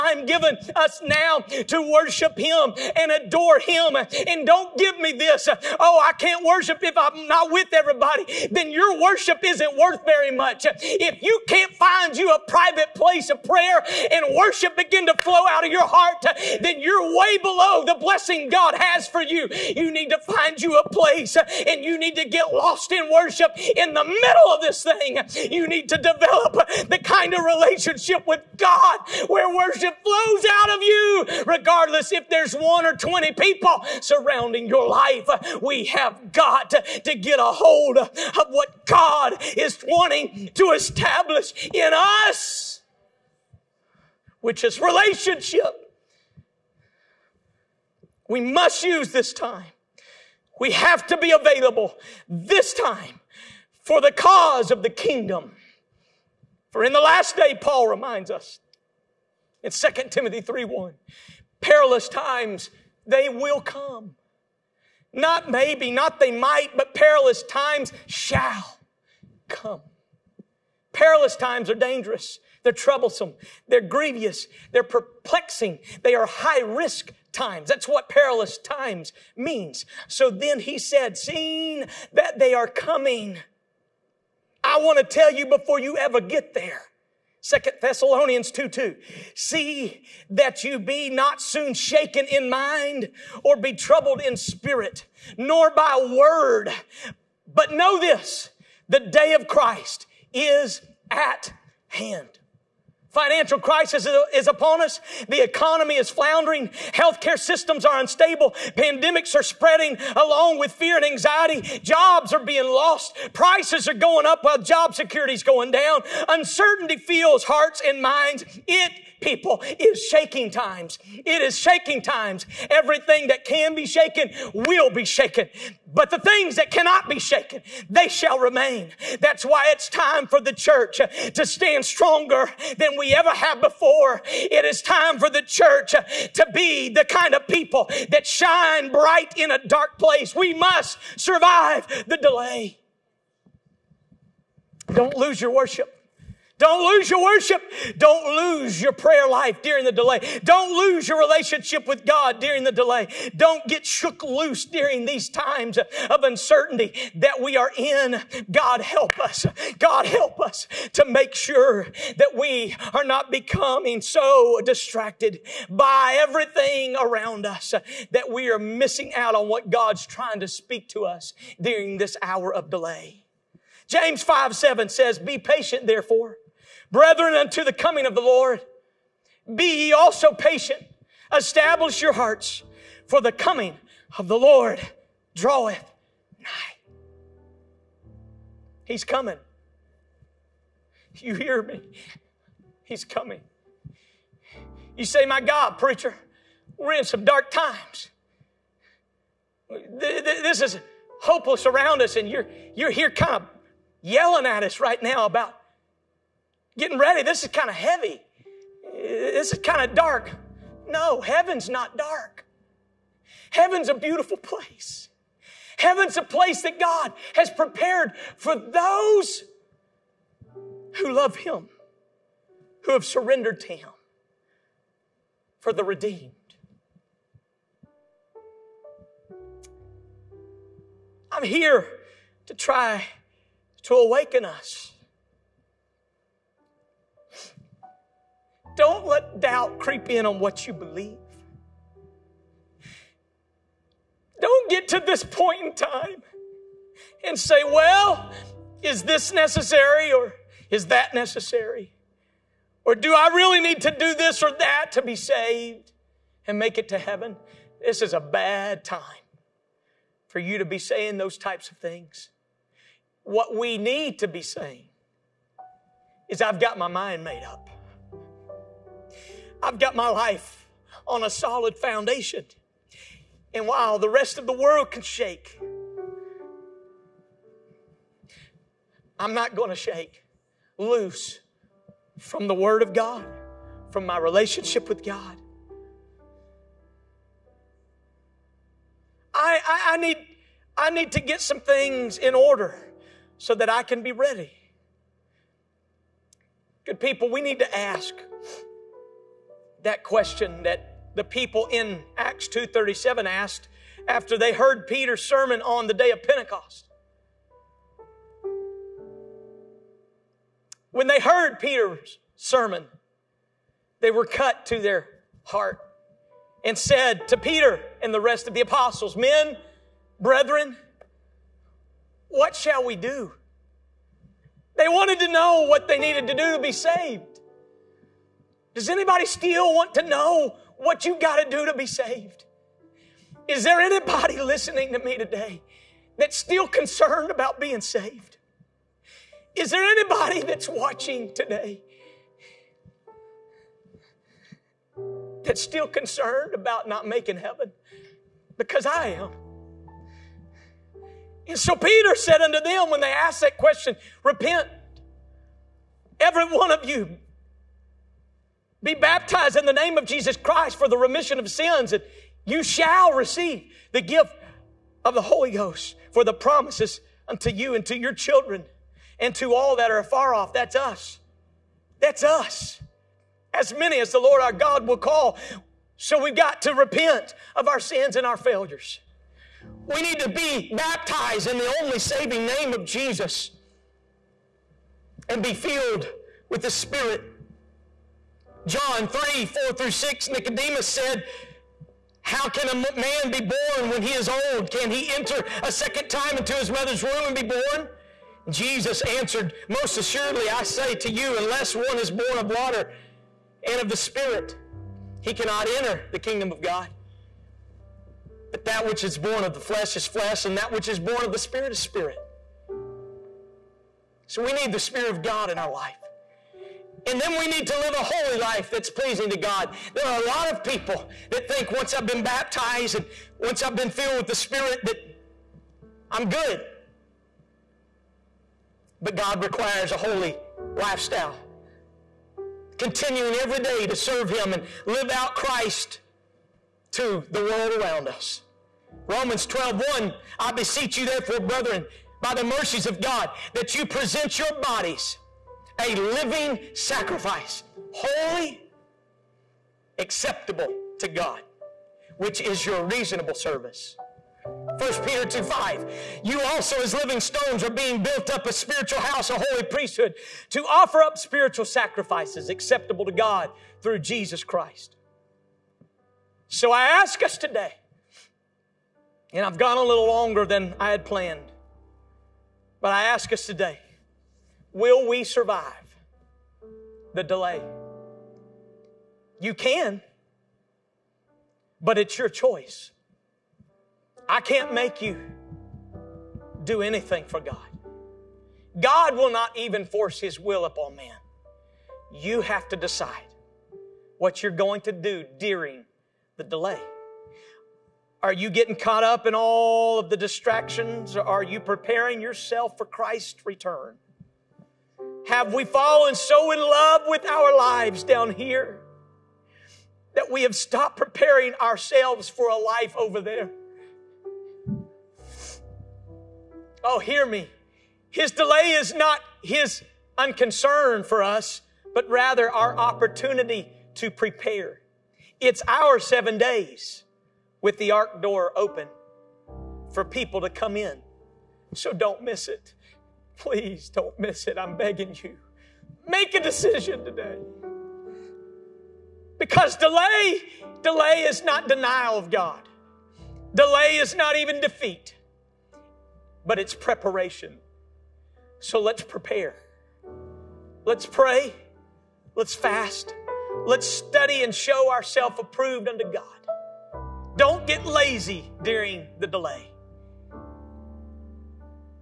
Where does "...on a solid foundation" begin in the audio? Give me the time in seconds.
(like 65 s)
271 s.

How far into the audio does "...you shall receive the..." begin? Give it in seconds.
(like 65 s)
362 s.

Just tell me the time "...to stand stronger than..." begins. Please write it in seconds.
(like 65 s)
131 s.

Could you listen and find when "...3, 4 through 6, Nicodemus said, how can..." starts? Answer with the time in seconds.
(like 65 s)
389 s.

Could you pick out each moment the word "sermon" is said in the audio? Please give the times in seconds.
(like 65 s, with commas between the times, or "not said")
305 s, 312 s.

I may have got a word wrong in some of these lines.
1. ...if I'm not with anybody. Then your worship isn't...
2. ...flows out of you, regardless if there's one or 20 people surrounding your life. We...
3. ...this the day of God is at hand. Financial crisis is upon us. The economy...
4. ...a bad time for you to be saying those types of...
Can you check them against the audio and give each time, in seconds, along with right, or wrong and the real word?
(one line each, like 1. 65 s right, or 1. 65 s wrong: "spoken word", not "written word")
1. 6 s wrong: "everybody", not "anybody"
2. 30 s right
3. 97 s wrong: "Christ", not "God"
4. 258 s right.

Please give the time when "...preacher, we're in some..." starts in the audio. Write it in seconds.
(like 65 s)
195 s.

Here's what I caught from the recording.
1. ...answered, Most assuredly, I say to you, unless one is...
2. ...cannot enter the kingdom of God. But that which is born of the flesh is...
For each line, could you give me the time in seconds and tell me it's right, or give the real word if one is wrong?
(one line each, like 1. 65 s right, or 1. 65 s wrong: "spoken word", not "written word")
1. 399 s right
2. 405 s right.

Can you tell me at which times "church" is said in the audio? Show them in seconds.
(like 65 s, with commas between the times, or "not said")
130 s, 135 s.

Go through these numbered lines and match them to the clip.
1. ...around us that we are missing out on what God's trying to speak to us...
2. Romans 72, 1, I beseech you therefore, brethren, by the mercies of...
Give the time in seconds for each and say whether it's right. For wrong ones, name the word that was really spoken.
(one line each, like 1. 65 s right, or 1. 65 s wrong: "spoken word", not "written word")
1. 166 s right
2. 439 s wrong: "12", not "72".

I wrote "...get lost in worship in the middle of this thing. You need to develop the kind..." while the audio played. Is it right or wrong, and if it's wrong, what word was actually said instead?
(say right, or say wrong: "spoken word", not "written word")
right.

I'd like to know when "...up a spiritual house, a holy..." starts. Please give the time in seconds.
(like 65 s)
458 s.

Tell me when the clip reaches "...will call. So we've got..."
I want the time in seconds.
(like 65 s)
374 s.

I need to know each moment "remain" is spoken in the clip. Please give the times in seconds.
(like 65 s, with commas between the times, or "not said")
128 s.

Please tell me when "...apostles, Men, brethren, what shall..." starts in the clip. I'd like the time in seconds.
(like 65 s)
318 s.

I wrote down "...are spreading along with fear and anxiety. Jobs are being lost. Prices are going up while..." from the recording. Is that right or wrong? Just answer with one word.
right.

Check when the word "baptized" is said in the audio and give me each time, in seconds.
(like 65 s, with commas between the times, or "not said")
358 s, 380 s, 422 s.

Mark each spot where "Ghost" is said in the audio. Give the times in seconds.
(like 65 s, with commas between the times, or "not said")
365 s.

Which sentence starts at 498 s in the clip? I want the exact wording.
Are you getting caught up in all of the distractions?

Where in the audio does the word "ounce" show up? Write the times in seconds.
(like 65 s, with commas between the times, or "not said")
not said.